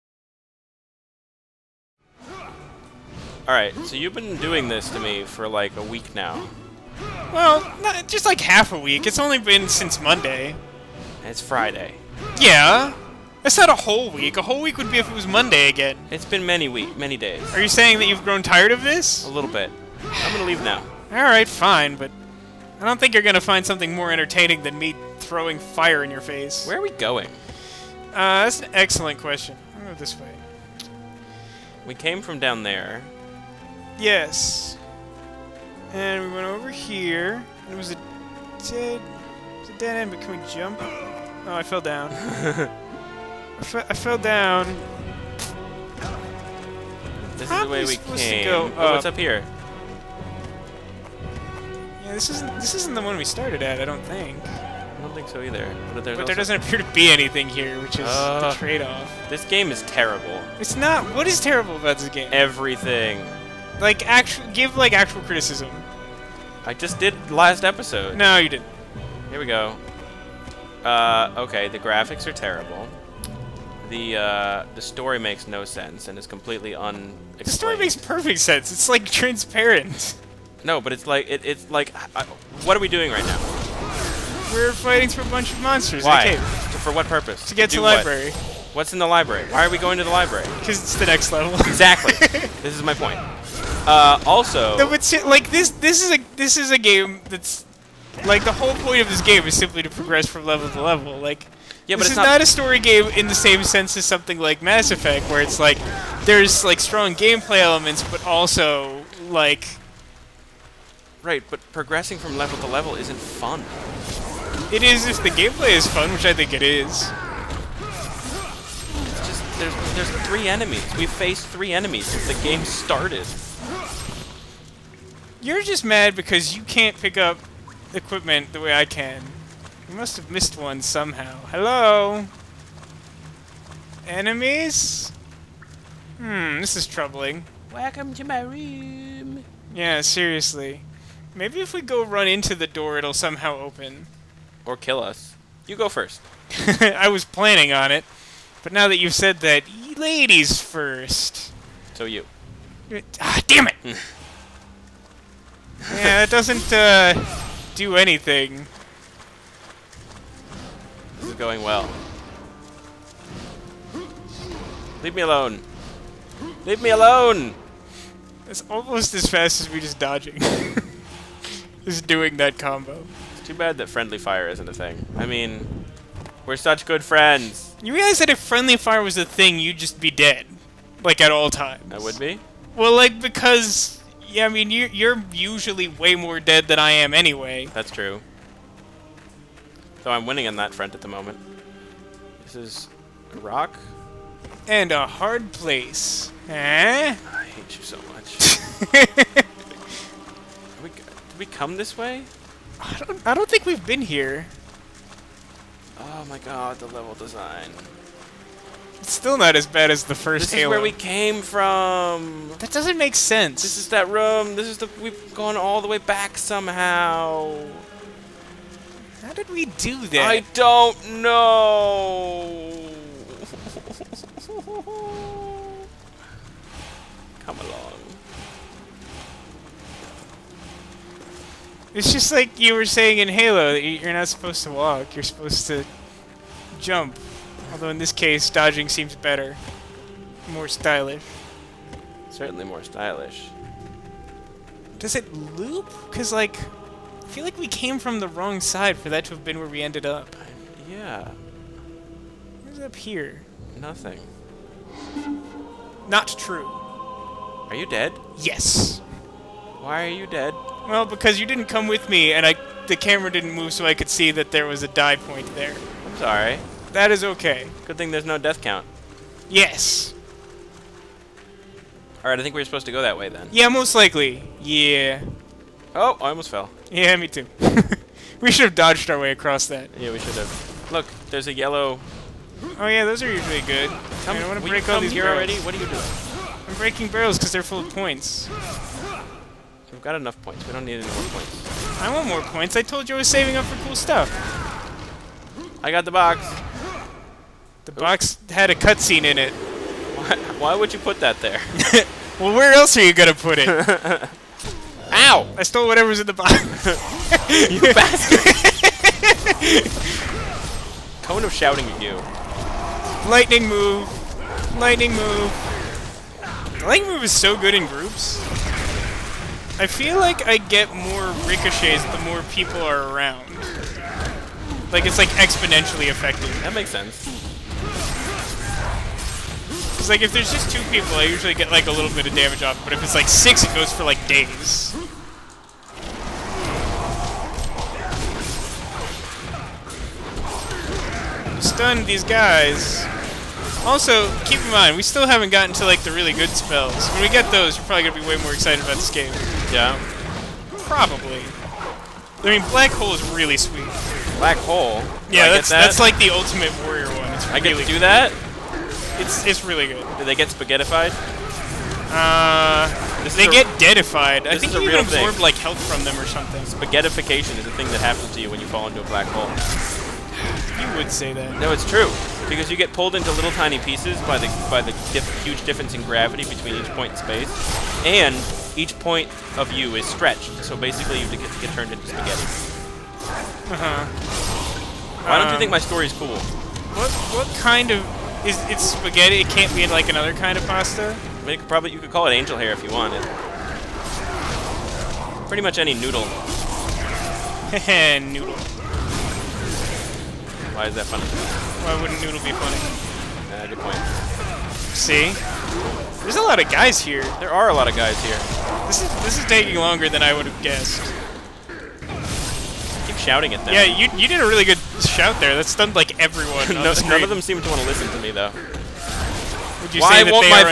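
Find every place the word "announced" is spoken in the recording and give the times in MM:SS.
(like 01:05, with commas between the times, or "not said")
not said.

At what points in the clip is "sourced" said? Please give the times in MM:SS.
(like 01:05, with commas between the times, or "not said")
not said.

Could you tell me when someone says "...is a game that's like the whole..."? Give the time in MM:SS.
01:36.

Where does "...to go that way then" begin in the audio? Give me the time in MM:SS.
04:32.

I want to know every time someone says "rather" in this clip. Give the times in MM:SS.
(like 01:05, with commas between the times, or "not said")
not said.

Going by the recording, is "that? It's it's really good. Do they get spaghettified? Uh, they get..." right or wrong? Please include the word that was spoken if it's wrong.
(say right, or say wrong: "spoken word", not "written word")
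right.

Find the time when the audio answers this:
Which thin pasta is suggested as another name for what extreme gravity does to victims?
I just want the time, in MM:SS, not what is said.
06:32.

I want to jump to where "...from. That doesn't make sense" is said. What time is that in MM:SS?
03:31.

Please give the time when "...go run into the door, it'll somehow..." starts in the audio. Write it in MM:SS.
02:21.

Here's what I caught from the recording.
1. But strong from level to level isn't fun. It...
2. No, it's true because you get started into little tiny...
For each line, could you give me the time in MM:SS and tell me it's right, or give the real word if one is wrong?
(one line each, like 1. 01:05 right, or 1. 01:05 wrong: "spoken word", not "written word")
1. 01:51 wrong: "progressing", not "strong"
2. 06:11 wrong: "pulled", not "started".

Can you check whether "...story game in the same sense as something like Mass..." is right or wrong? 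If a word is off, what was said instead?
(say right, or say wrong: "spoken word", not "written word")
right.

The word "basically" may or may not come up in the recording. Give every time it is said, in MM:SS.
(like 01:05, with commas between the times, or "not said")
06:20.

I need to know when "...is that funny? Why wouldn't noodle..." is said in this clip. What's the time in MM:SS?
06:40.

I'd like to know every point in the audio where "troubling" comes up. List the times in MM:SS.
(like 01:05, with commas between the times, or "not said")
02:16.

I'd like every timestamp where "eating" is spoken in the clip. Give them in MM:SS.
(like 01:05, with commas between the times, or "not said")
not said.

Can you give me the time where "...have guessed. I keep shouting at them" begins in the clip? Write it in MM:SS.
06:50.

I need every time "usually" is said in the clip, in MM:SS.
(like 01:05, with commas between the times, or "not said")
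03:05, 04:43, 05:31.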